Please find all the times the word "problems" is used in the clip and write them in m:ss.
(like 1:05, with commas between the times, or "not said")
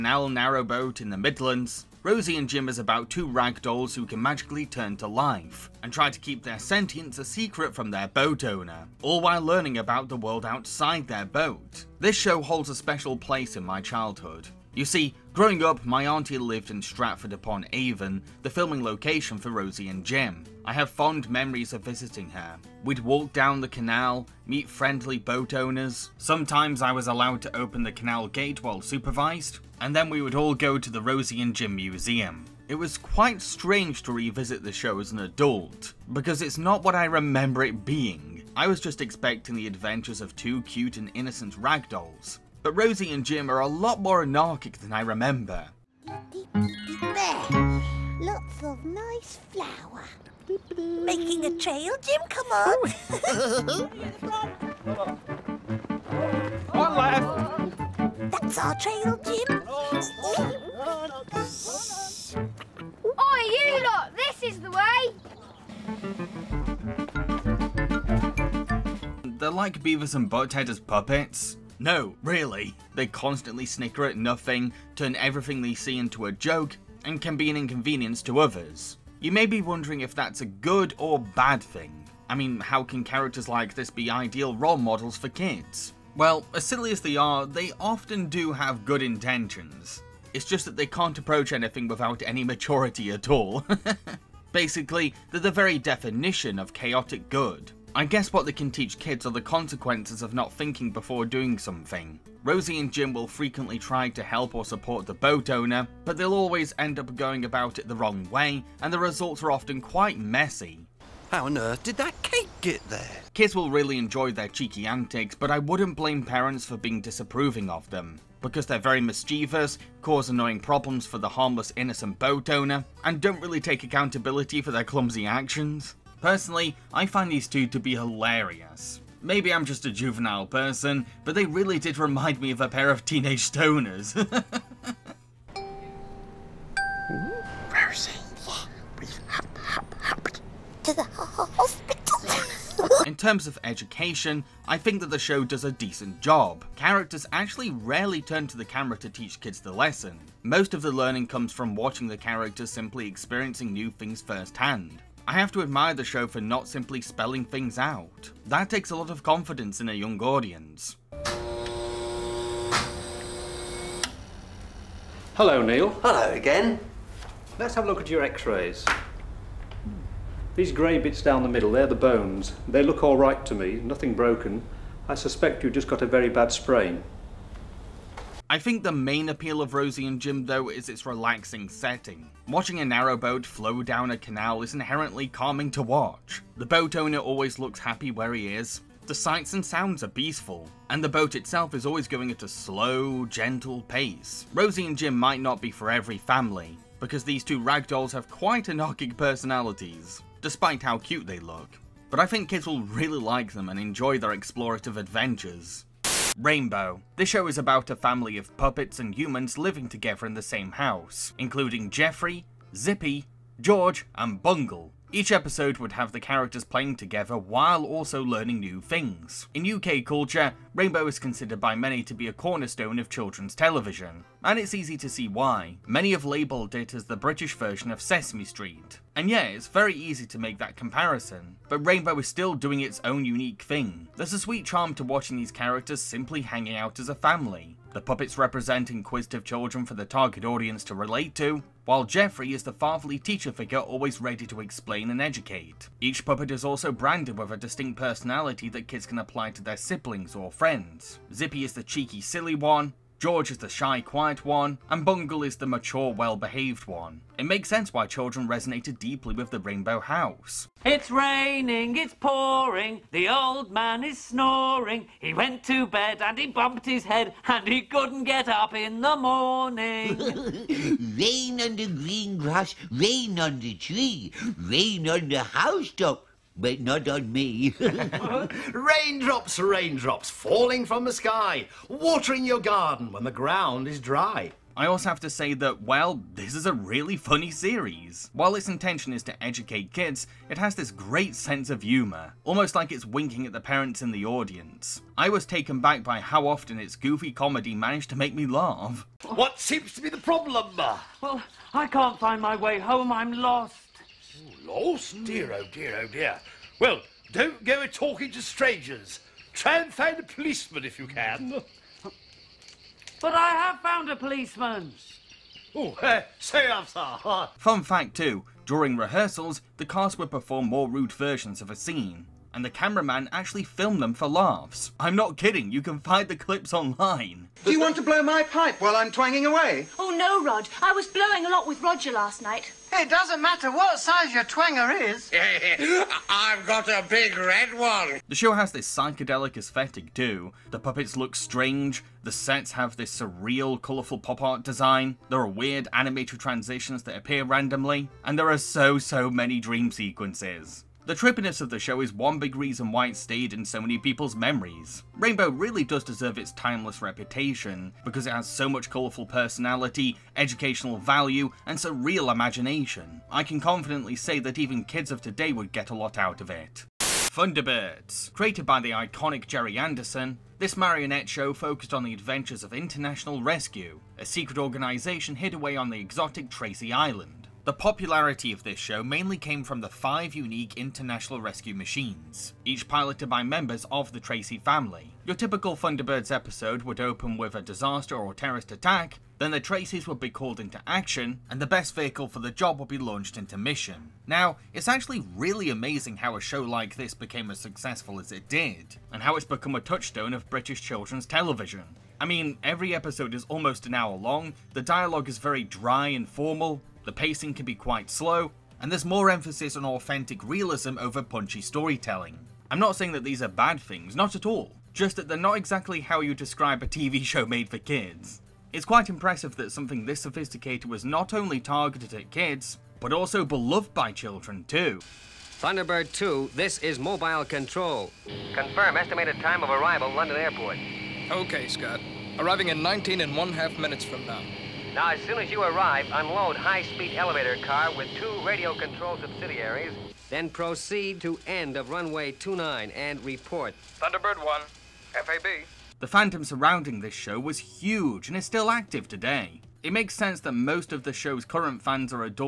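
2:00, 5:00.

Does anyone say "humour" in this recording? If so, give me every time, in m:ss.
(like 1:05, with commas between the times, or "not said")
4:51.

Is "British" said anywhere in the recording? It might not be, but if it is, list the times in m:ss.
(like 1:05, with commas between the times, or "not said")
3:47, 6:40.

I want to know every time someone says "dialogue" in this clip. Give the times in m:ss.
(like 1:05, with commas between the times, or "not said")
6:44.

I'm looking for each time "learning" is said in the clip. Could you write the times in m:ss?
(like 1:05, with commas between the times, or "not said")
0:09, 2:30, 3:38.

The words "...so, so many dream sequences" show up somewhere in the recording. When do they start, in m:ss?
5:48.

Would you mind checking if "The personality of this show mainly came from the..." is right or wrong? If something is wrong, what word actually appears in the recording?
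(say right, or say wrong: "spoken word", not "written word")
wrong: "popularity", not "personality".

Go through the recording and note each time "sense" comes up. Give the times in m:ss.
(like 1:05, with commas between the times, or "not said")
4:17, 4:51, 7:30.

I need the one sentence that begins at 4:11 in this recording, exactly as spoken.
Zippy is the cheeky silly one, George is the shy, quiet one, and Bungle is the mature, well-behaved one.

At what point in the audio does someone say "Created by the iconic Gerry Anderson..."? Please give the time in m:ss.
6:08.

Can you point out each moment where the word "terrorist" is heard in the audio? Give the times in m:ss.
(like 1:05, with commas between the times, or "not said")
6:28.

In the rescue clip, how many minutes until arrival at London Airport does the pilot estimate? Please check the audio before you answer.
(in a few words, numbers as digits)
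19 and a half.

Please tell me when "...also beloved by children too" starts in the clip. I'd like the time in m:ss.
7:03.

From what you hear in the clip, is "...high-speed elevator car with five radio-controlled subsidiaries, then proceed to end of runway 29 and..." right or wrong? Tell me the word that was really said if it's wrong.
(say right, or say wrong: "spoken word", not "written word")
wrong: "two", not "five".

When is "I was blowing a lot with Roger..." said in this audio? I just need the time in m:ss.
5:30.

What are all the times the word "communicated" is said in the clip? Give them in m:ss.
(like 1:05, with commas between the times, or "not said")
not said.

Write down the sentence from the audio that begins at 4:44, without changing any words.
I also have to say that, well, this is a really funny series.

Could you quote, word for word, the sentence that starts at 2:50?
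These grey bits down the middle, they're the bones.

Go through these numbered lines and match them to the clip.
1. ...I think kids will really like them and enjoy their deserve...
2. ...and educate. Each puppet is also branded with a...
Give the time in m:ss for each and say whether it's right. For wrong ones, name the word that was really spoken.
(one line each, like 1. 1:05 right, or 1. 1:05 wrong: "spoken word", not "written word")
1. 3:22 wrong: "explorative", not "deserve"
2. 4:05 right.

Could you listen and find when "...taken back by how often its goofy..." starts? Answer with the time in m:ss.
4:55.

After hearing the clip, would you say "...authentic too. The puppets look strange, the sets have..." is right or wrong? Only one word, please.
wrong.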